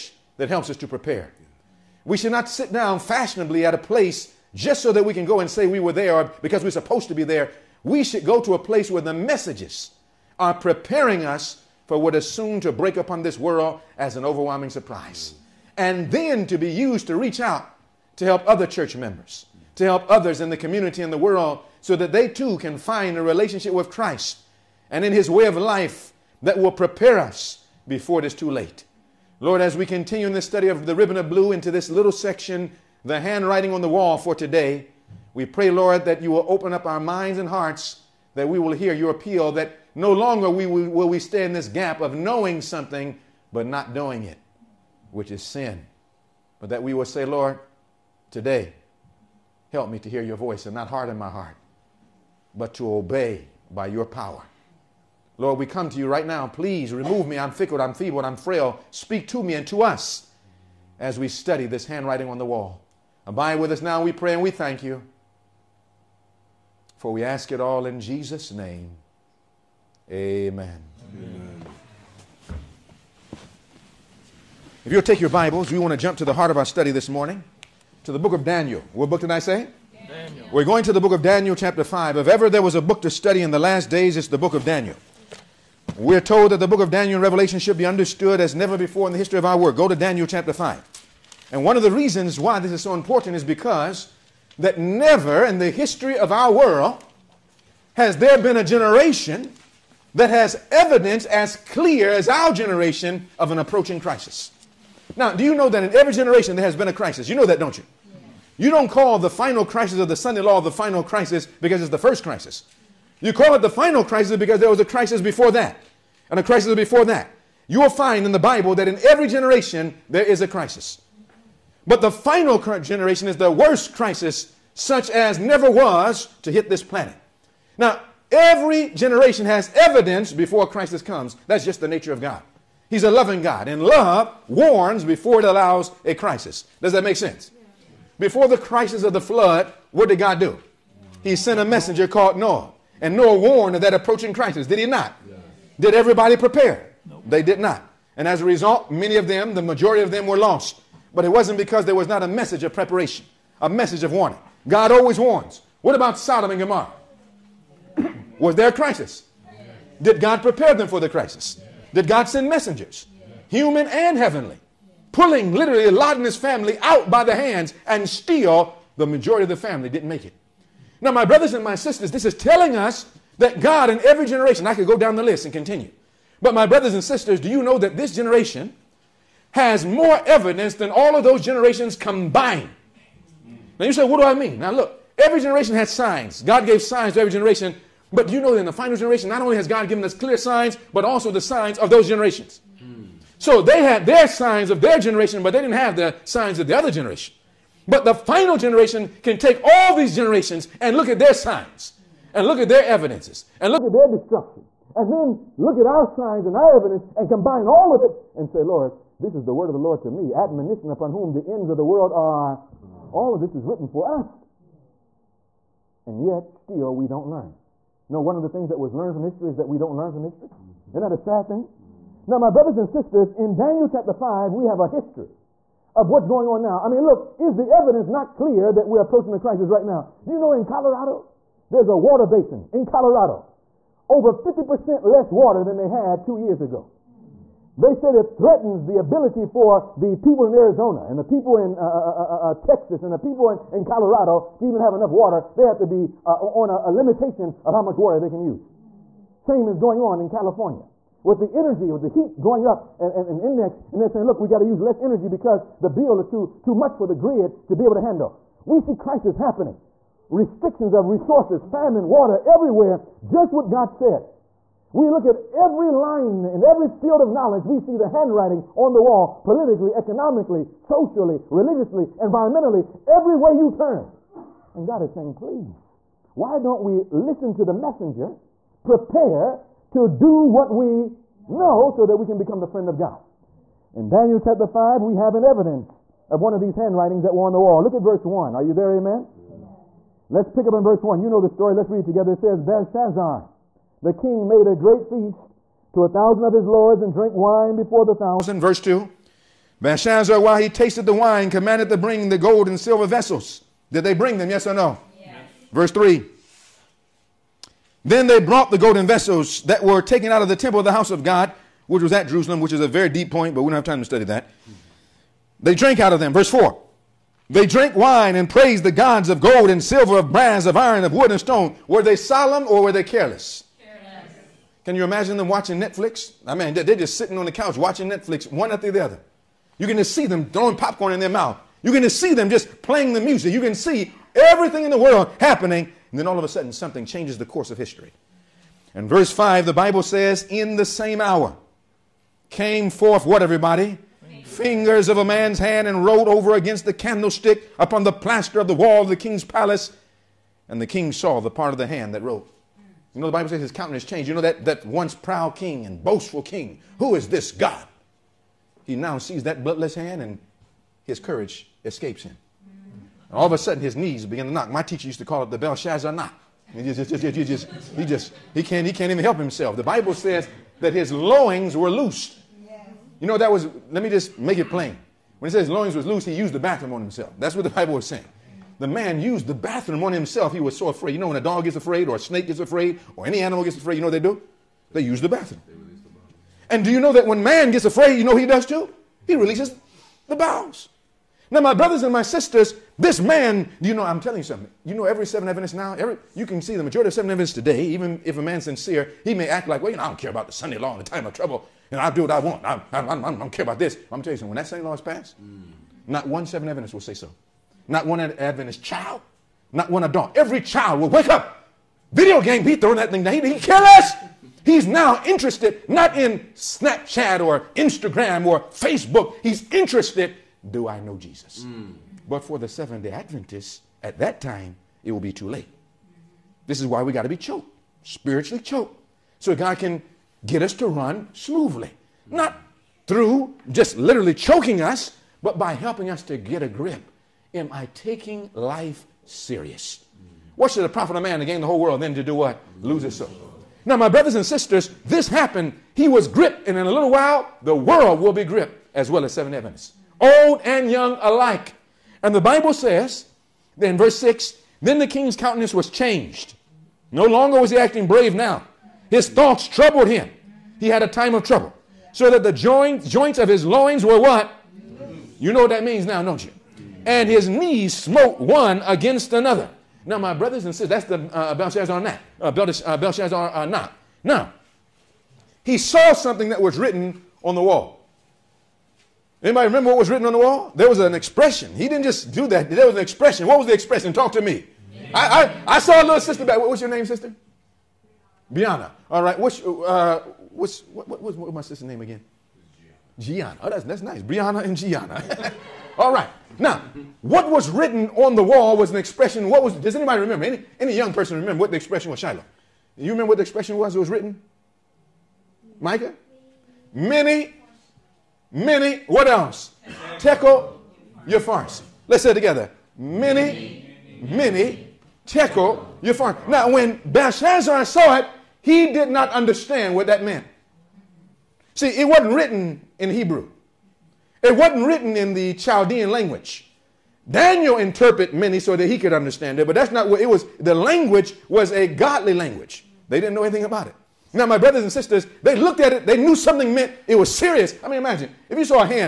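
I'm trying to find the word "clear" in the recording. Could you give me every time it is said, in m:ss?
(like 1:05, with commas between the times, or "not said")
1:41, 3:10, 3:48.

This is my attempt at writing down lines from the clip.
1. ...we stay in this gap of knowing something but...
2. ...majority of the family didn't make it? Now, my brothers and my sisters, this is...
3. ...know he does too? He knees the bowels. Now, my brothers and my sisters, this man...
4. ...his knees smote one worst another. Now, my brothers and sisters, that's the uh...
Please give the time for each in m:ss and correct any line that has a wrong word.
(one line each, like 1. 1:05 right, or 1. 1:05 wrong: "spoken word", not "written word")
1. 0:41 right
2. 2:49 right
3. 6:28 wrong: "releases", not "knees"
4. 7:47 wrong: "against", not "worst".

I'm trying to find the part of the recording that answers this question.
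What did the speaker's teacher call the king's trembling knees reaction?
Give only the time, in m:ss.
6:05.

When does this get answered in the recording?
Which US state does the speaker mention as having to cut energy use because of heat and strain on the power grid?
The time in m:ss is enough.
4:09.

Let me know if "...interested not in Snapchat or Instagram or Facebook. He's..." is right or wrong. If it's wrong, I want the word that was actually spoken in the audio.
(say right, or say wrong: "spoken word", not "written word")
right.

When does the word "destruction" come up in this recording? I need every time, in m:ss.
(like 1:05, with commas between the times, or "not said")
3:24.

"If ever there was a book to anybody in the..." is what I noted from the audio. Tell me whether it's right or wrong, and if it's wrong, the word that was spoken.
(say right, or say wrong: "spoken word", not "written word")
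wrong: "study", not "anybody".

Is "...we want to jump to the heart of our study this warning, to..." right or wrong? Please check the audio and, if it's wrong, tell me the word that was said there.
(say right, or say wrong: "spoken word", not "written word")
wrong: "morning", not "warning".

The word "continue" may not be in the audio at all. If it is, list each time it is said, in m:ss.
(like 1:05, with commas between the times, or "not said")
0:29, 2:55.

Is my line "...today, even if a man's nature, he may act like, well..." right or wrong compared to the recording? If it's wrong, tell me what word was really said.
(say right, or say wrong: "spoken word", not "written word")
wrong: "sincere", not "nature".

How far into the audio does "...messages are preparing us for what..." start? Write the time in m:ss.
0:09.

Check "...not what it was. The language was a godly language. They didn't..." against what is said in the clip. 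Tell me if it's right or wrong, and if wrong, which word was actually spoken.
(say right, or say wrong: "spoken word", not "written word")
right.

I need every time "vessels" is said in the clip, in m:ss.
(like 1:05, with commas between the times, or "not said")
5:03, 5:09.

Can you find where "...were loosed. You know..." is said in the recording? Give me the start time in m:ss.
6:11.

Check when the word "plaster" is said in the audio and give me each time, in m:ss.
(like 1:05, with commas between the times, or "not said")
5:48.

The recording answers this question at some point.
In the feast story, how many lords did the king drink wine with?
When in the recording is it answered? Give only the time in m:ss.
4:56.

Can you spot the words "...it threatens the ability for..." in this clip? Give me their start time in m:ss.
3:58.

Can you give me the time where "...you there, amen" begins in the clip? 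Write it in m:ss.
4:48.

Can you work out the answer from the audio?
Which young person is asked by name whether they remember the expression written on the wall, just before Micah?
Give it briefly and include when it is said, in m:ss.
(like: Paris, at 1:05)
Shiloh, at 8:22.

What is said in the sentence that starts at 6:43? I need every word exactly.
I'm going to tell you something.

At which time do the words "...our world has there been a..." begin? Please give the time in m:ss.
1:36.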